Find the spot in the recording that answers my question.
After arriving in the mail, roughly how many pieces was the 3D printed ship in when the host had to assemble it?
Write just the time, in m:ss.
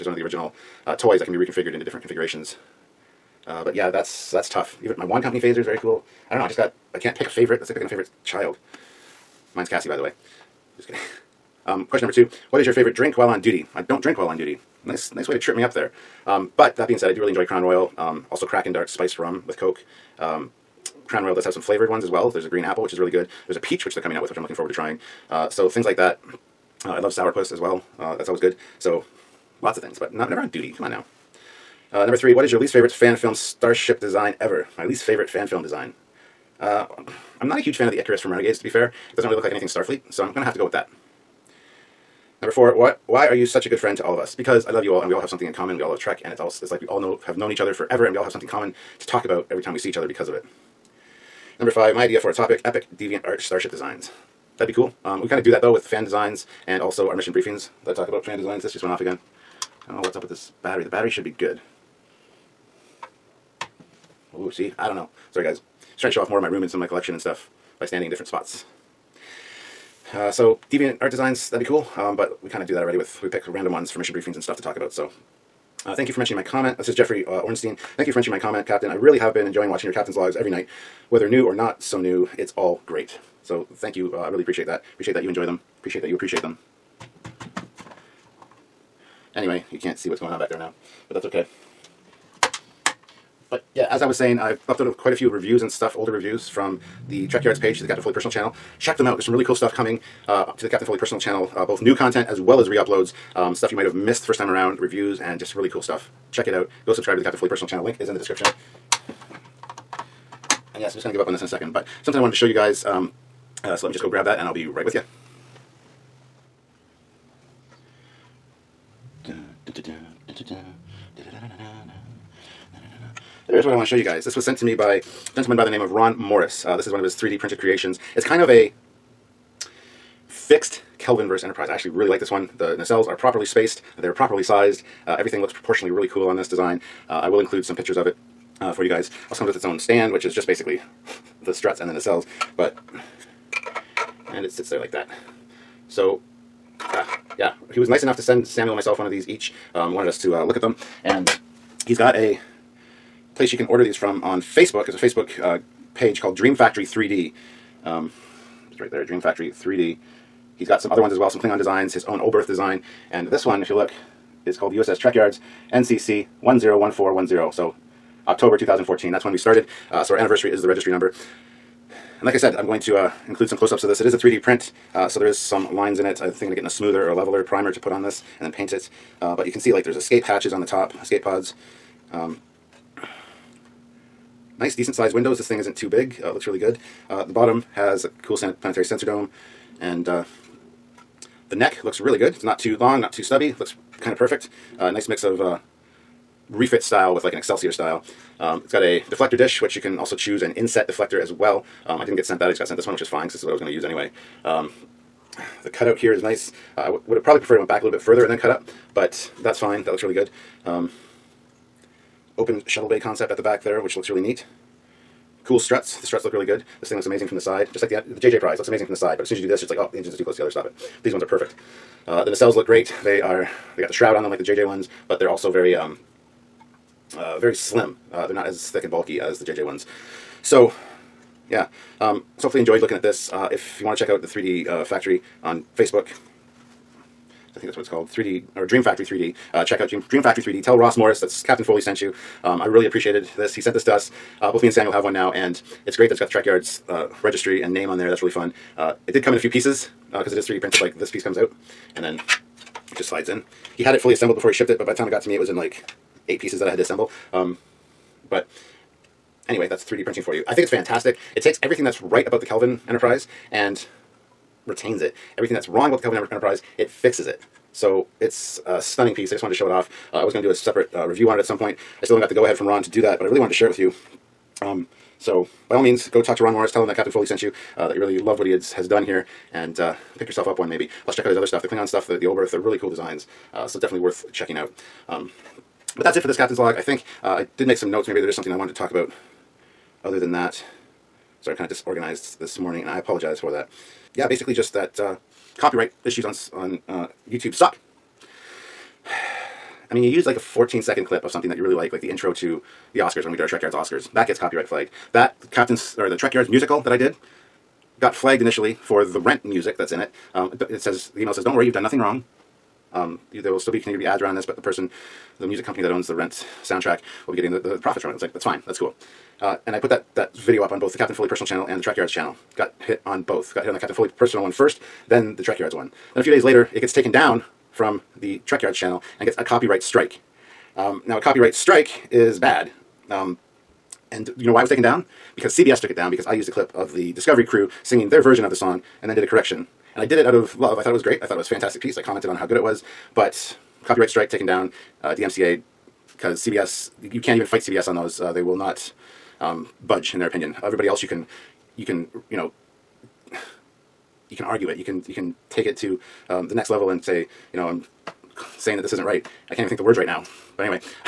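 4:16.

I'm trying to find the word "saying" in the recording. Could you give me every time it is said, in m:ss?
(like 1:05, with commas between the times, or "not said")
1:34, 5:58.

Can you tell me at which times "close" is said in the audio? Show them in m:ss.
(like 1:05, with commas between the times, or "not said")
2:53, 3:40.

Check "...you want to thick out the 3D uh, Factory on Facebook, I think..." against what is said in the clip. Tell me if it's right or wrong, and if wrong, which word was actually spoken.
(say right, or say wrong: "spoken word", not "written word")
wrong: "check", not "thick".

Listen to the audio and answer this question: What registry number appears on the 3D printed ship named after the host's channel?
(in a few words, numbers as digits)
NCC 101410.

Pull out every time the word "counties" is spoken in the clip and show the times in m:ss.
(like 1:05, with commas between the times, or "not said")
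not said.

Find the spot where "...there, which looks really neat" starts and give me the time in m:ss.
3:33.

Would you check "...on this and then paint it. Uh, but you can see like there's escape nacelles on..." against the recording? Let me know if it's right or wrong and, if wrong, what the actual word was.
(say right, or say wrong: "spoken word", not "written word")
wrong: "hatches", not "nacelles".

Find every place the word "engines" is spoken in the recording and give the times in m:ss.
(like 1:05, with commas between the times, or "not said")
3:39.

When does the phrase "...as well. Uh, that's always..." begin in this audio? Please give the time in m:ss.
0:27.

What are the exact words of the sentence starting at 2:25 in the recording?
So, uh, yeah, he was nice enough to send Samuel and myself one of these each.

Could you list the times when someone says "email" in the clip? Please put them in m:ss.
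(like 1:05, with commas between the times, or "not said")
5:11.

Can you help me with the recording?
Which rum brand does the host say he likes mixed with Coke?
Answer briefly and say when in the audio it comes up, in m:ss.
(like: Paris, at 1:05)
Kraken, at 0:18.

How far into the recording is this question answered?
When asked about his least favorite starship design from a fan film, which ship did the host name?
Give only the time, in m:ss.
0:37.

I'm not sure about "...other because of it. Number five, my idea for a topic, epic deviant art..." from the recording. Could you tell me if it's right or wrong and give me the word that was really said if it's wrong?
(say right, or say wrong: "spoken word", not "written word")
right.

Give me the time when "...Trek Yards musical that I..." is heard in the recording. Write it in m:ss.
5:06.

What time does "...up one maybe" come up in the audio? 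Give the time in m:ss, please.
4:40.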